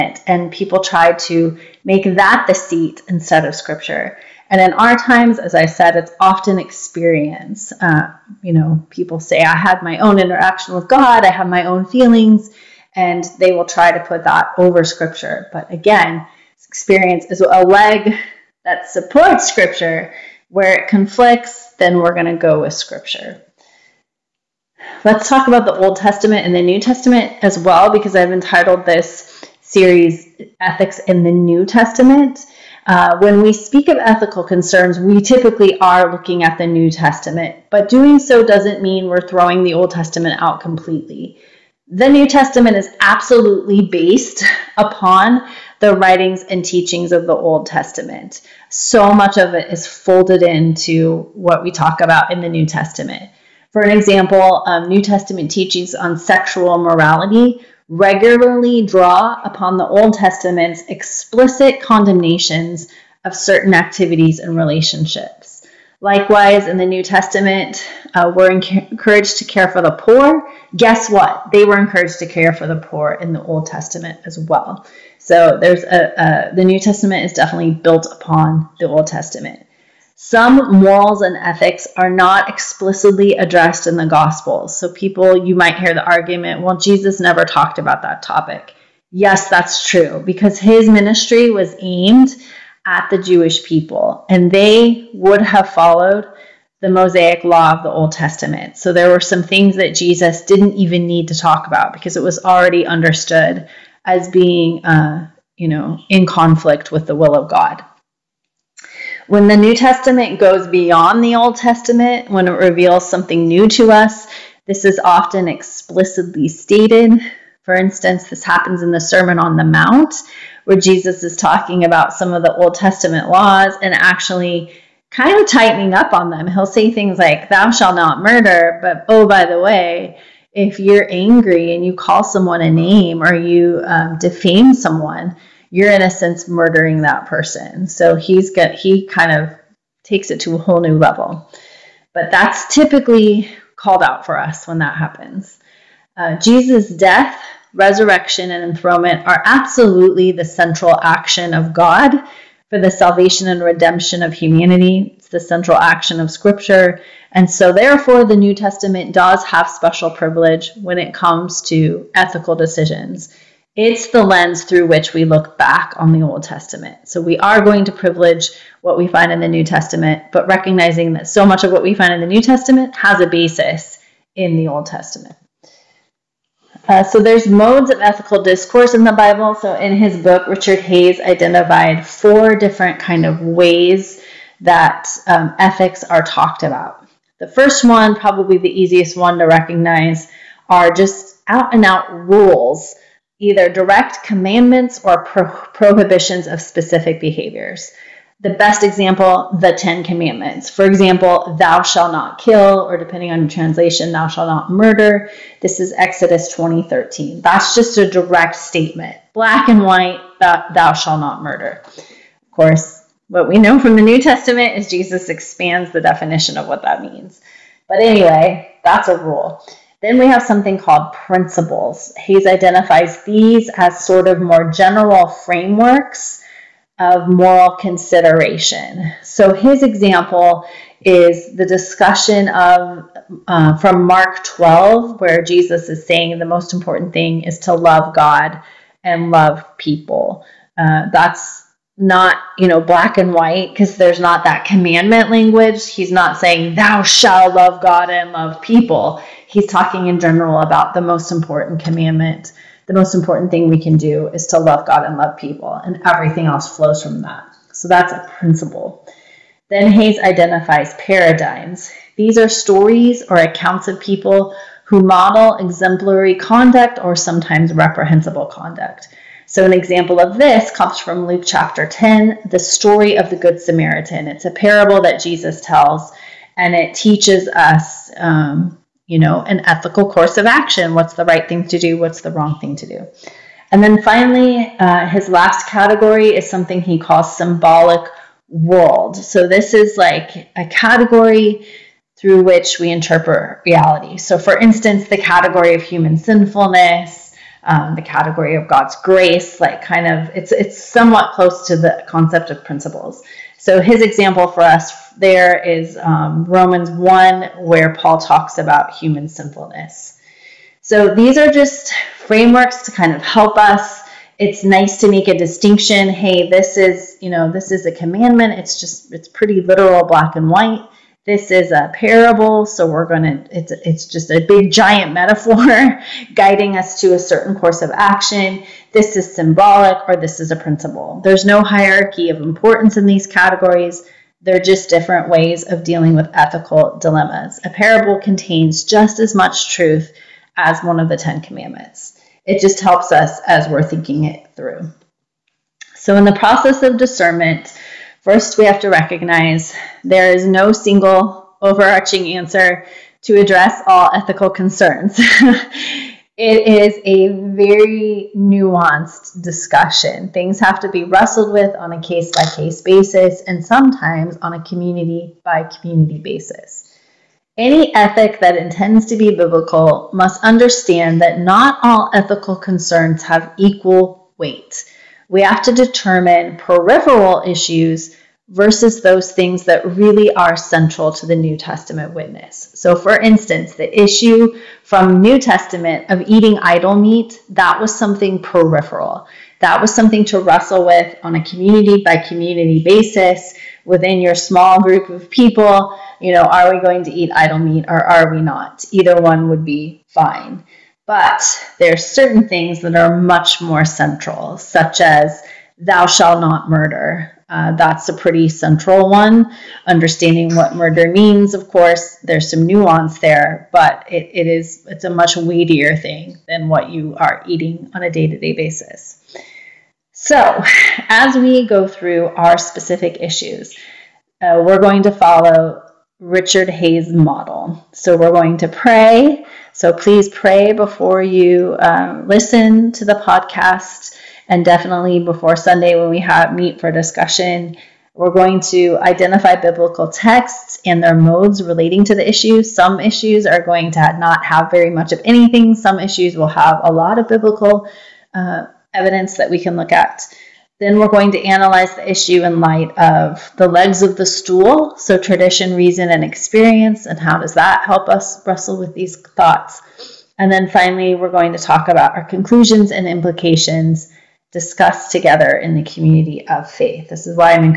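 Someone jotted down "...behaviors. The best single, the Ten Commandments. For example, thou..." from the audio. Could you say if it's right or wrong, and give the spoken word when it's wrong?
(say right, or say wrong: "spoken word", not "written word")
wrong: "example", not "single".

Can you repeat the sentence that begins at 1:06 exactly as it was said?
Likewise, in the New Testament, uh, we're encouraged to care for the poor.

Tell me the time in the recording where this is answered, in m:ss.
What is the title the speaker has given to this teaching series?
0:30.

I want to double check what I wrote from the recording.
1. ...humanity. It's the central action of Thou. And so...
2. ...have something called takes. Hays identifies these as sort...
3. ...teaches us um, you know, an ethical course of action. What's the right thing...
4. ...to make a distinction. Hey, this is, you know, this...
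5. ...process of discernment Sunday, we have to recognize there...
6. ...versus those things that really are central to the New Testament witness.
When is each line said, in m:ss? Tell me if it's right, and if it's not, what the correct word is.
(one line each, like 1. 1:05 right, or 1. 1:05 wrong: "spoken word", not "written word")
1. 2:34 wrong: "Scripture", not "Thou"
2. 3:40 wrong: "principles", not "takes"
3. 4:36 right
4. 5:14 right
5. 5:46 wrong: "First", not "Sunday"
6. 6:18 right.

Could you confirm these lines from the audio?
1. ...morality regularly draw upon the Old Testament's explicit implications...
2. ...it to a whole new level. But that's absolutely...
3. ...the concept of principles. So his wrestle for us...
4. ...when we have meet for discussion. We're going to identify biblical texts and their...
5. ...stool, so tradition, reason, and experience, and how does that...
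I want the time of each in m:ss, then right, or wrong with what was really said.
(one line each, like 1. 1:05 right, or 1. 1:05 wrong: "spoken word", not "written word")
1. 0:56 wrong: "condemnations", not "implications"
2. 2:20 wrong: "typically", not "absolutely"
3. 5:01 wrong: "example", not "wrestle"
4. 7:15 right
5. 7:34 right.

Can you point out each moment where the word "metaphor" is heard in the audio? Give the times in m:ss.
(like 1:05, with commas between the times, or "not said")
5:25.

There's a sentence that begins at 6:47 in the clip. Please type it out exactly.
Uh, that's a pretty central one.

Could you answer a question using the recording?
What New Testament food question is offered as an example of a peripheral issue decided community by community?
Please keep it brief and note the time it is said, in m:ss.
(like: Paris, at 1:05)
eating idol meat, at 6:26.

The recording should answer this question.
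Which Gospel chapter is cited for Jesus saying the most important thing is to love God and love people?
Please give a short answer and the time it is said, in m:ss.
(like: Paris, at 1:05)
Mark 12, at 3:54.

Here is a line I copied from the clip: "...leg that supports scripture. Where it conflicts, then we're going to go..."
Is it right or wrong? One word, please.
right.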